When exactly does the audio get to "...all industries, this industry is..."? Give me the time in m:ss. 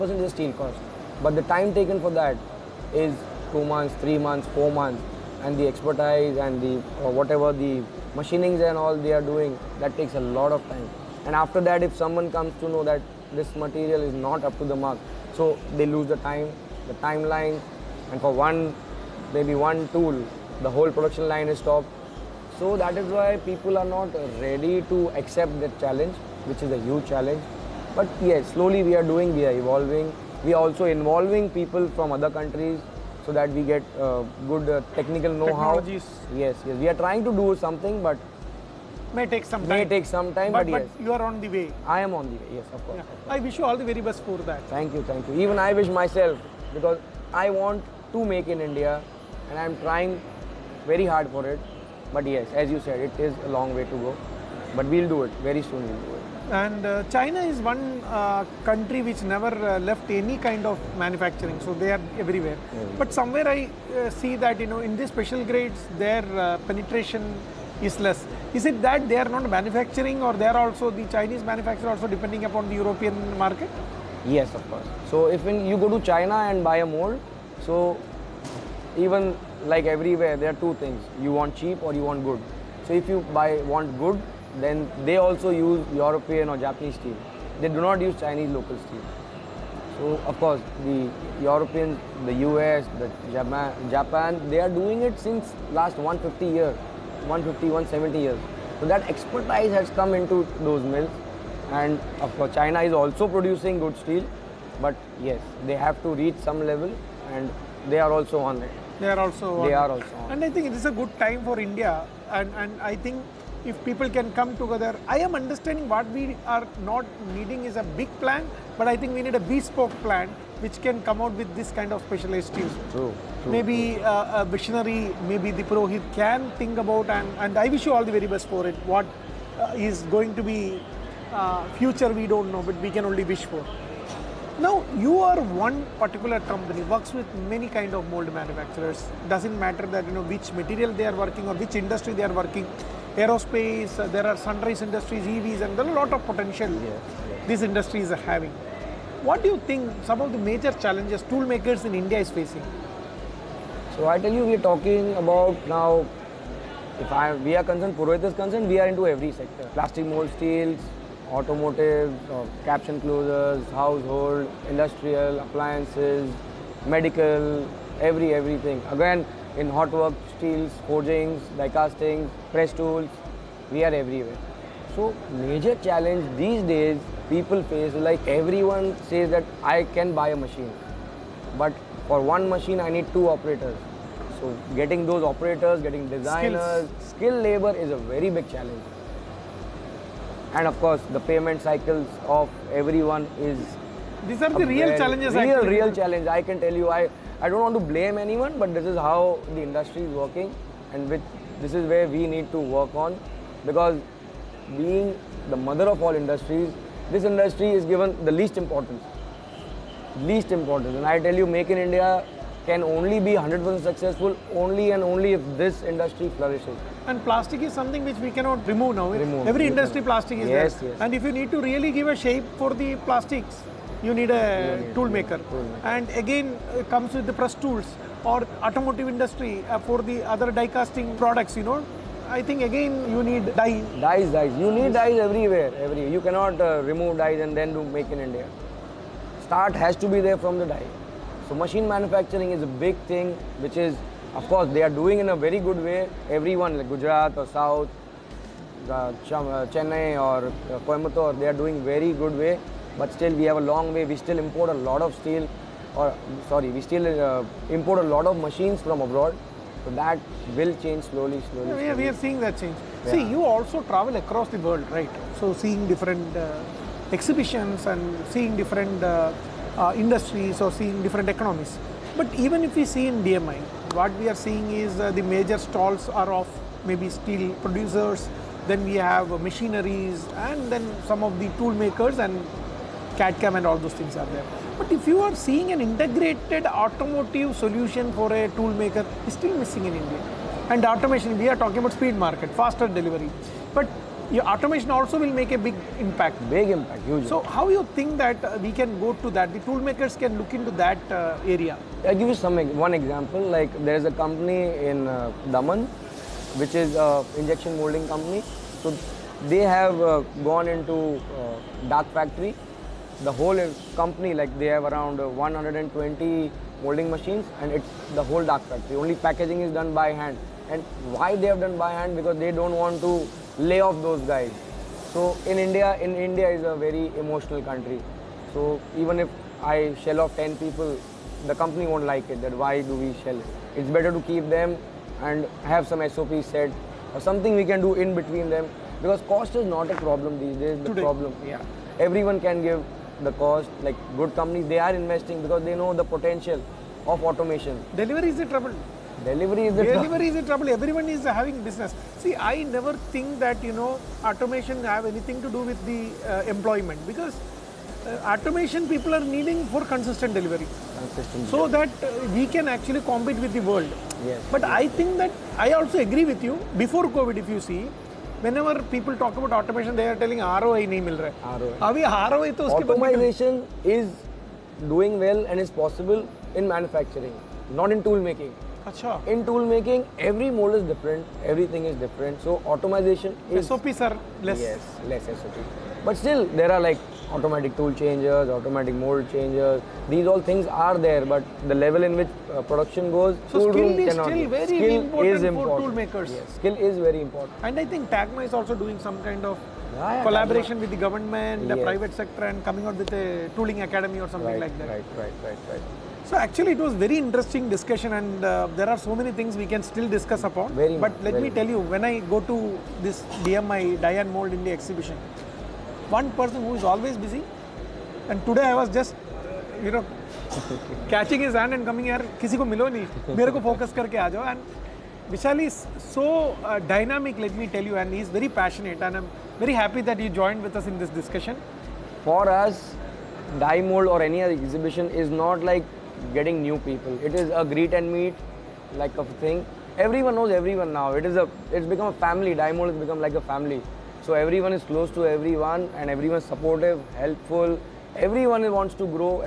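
3:26.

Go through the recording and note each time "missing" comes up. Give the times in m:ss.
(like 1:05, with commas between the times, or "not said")
4:49.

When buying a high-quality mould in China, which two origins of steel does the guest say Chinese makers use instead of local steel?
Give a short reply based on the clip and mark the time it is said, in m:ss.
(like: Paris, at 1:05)
European or Japanese, at 1:25.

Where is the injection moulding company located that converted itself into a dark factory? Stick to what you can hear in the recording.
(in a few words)
Daman.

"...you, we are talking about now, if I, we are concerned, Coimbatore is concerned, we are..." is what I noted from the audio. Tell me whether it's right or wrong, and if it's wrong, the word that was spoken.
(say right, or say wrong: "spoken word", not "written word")
wrong: "Purohit", not "Coimbatore".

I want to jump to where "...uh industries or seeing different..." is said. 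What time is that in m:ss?
4:29.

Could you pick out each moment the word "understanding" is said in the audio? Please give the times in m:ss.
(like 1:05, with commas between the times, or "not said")
1:55.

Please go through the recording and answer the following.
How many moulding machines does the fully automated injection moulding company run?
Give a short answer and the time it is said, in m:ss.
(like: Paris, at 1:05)
120, at 5:15.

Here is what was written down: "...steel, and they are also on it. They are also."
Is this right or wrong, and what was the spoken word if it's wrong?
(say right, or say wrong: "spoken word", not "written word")
wrong: "level", not "steel".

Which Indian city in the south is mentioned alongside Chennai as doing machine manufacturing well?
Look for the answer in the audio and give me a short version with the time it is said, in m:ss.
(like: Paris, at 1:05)
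Coimbatore, at 4:10.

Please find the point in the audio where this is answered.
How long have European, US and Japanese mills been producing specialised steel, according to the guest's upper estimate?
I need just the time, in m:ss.
1:37.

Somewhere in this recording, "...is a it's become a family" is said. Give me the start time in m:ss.
7:21.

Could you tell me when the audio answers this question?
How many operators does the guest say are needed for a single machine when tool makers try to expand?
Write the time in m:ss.
3:03.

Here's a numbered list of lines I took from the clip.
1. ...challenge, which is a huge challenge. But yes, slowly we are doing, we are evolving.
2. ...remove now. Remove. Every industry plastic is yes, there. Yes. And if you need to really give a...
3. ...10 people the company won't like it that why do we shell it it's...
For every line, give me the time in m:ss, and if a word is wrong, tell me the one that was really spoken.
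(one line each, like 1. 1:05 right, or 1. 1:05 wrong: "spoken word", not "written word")
1. 0:25 right
2. 3:38 right
3. 5:30 right.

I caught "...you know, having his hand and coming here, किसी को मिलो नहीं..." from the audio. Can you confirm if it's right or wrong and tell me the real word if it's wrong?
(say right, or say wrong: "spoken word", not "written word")
wrong: "catching", not "having".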